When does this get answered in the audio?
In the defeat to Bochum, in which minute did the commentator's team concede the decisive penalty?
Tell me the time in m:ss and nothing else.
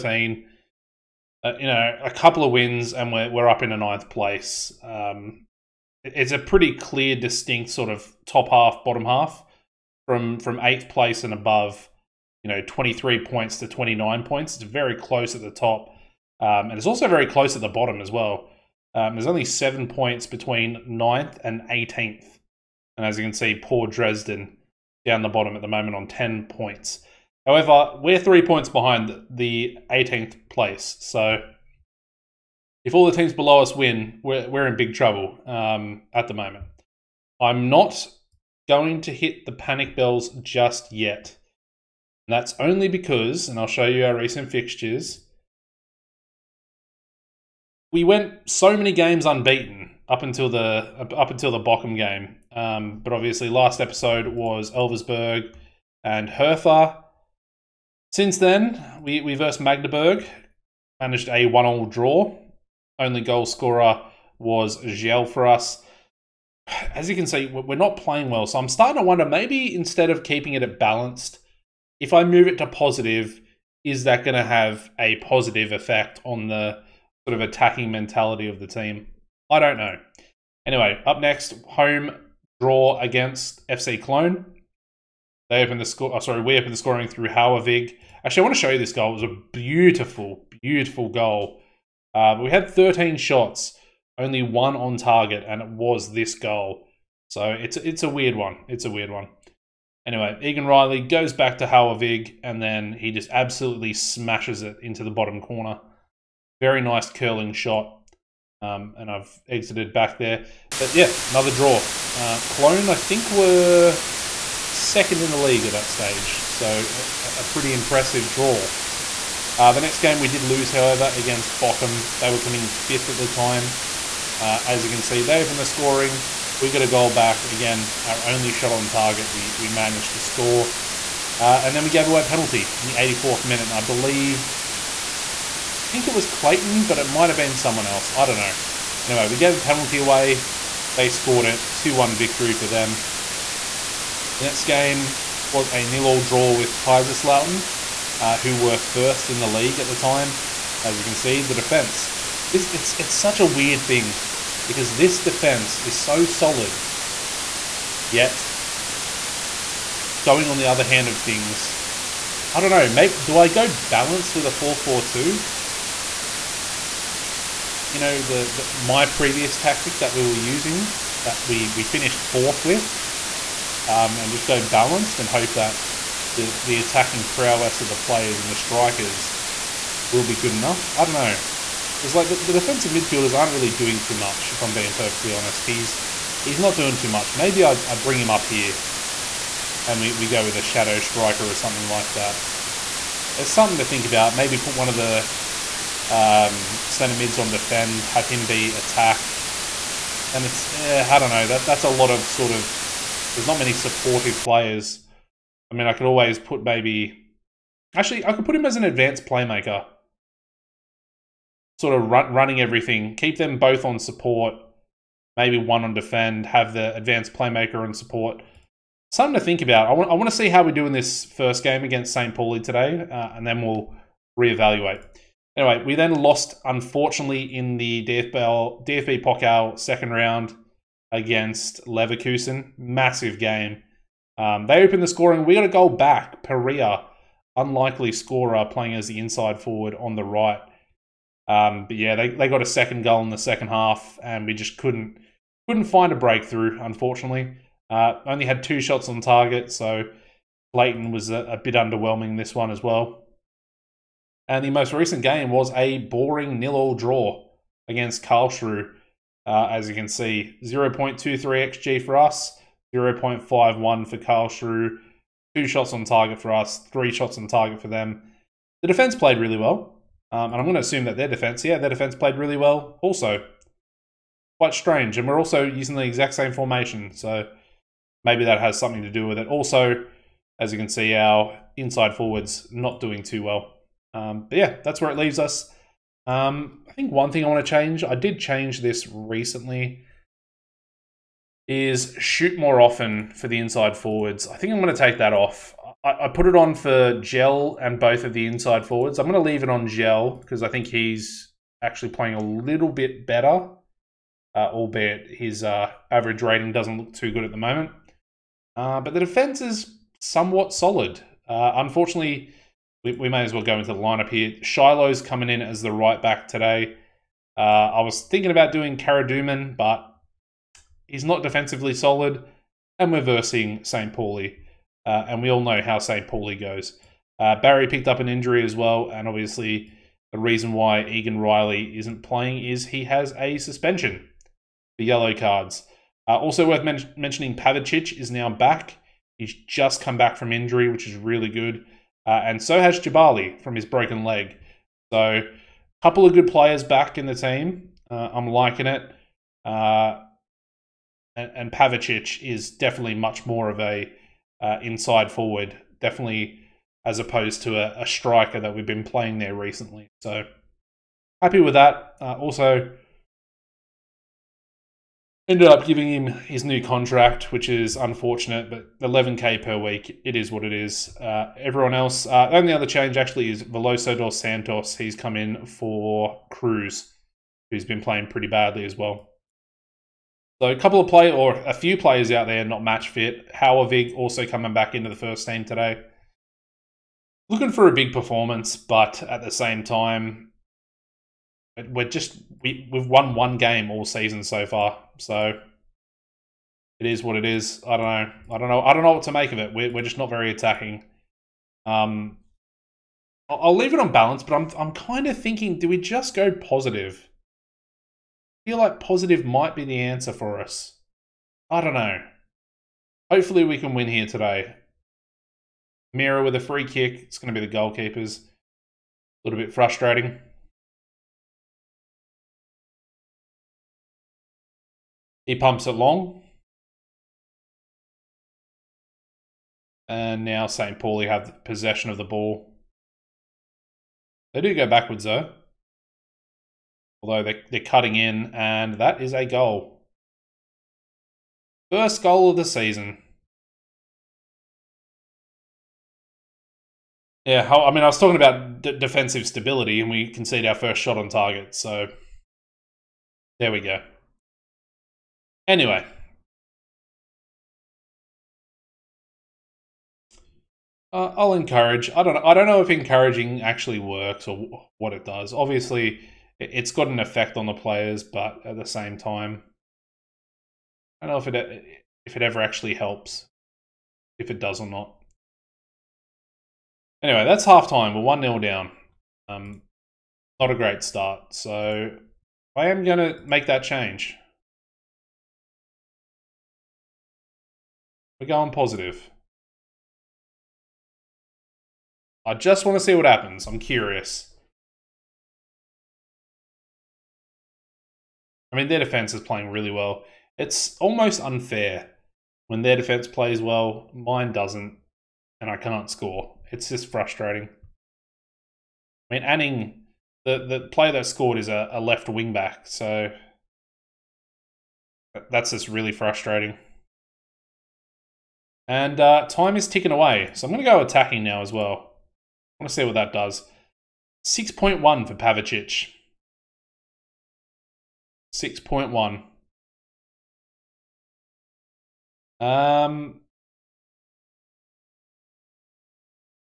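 2:12.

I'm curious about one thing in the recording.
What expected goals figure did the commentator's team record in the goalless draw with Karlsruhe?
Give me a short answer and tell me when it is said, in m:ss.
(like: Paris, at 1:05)
0.23, at 4:20.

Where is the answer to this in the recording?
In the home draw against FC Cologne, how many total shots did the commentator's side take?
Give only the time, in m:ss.
1:32.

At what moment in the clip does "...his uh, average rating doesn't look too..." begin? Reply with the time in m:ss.
5:05.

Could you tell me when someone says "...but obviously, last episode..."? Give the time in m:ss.
0:52.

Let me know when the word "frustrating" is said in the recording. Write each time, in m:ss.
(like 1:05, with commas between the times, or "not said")
6:59, 8:27, 8:36.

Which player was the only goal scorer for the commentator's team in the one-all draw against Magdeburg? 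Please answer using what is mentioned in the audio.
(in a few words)
Giel.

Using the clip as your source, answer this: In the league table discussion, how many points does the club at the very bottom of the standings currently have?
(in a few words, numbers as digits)
10.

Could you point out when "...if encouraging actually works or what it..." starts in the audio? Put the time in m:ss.
7:42.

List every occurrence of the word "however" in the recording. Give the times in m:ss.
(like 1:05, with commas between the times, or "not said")
0:27, 2:00.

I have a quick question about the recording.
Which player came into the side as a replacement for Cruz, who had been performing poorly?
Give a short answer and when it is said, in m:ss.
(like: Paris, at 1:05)
Veloso dos Santos, at 6:13.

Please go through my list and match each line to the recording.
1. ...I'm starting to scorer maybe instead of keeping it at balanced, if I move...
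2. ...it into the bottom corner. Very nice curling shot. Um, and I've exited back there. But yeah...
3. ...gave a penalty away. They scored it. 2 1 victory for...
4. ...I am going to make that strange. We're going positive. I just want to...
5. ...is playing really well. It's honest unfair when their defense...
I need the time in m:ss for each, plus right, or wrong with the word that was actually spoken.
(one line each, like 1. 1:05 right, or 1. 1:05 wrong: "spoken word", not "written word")
1. 1:08 wrong: "wonder", not "scorer"
2. 1:44 right
3. 2:19 right
4. 8:02 wrong: "change", not "strange"
5. 8:19 wrong: "almost", not "honest".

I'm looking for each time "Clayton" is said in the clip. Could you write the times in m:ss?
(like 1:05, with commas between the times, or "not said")
2:16.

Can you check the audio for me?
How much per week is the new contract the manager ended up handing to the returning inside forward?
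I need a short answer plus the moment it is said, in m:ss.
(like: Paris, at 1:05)
11k, at 6:08.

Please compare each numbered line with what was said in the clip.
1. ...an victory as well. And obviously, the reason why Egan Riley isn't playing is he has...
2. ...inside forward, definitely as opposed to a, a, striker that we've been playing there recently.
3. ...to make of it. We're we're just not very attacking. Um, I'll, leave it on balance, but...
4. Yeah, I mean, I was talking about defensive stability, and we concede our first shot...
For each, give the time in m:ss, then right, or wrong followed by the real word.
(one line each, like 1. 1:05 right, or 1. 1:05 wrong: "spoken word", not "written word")
1. 5:28 wrong: "injury", not "victory"
2. 5:54 right
3. 6:39 right
4. 7:27 right.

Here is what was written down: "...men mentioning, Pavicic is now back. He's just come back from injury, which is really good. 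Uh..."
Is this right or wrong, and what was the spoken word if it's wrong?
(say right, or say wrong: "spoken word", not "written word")
right.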